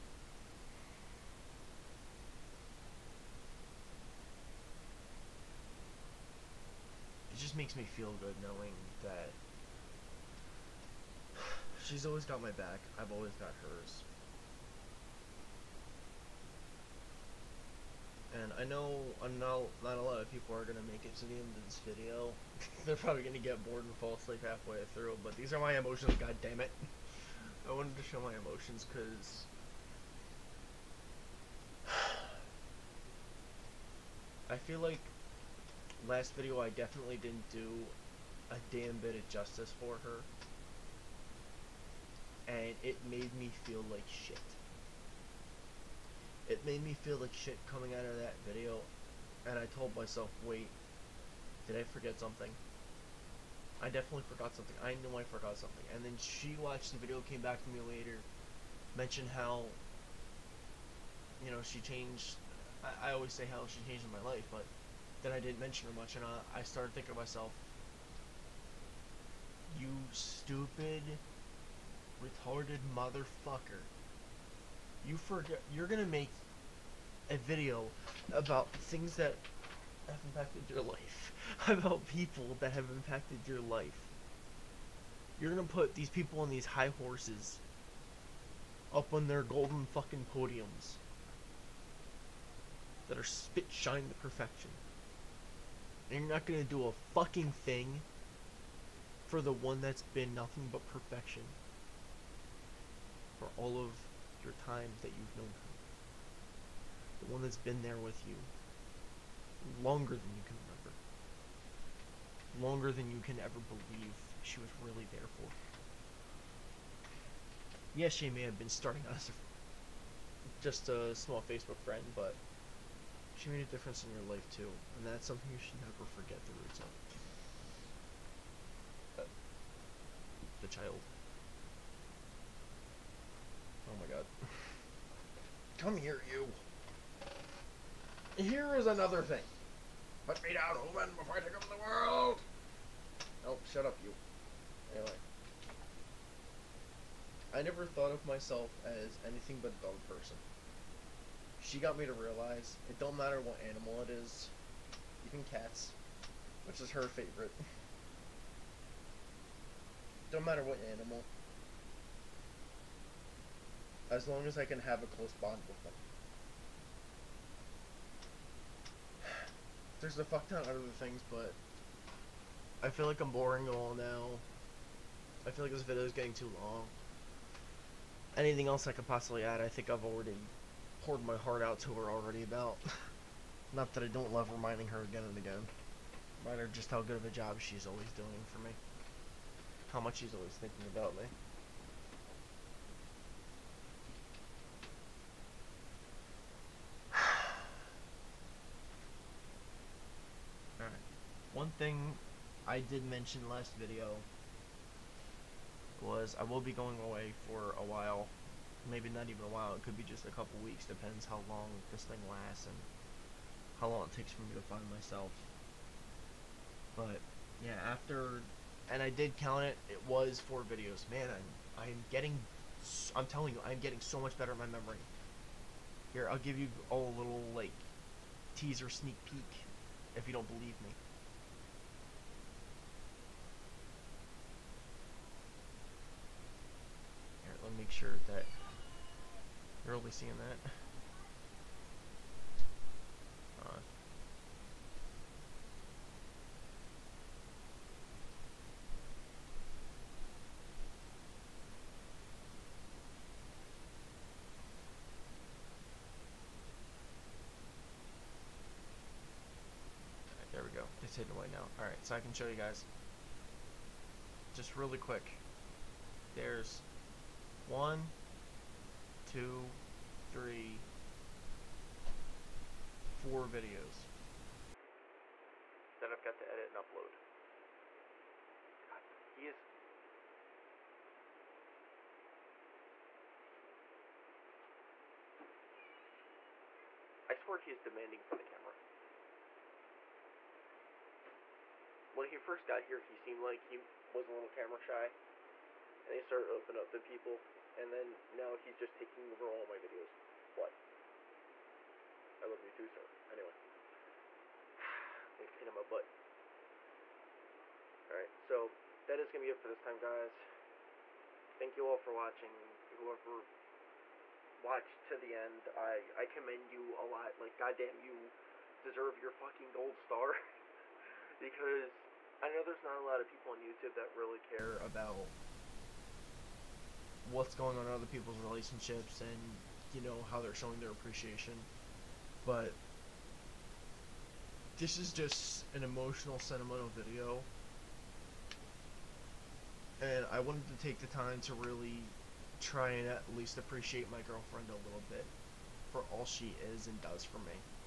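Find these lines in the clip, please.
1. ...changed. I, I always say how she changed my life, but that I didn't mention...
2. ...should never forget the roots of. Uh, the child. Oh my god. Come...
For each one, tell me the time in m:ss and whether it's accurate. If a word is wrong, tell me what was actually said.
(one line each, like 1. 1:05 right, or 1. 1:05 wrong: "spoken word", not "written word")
1. 1:01 right
2. 2:05 right.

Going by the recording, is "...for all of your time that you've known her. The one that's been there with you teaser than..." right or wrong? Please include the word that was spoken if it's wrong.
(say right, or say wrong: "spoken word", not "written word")
wrong: "longer", not "teaser".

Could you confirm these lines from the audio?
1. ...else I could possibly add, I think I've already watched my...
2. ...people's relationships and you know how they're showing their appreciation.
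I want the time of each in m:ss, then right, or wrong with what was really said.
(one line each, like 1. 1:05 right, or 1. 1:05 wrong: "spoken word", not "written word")
1. 2:58 wrong: "poured", not "watched"
2. 5:28 right.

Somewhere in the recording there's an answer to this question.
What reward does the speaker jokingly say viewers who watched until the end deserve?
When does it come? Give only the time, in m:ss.
5:19.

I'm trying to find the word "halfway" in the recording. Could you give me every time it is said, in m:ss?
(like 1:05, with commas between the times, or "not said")
0:24.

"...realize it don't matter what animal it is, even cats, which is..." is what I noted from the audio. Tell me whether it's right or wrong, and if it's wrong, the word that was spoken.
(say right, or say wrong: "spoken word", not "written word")
right.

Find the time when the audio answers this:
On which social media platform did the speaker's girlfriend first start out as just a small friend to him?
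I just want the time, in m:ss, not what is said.
2:01.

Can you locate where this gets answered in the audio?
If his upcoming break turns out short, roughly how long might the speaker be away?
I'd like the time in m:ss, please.
3:30.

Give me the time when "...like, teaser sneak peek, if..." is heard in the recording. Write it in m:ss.
3:47.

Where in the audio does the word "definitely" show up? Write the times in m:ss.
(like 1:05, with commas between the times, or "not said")
0:36, 0:53.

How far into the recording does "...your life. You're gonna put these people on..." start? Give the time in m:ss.
1:23.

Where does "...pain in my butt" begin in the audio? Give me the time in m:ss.
5:05.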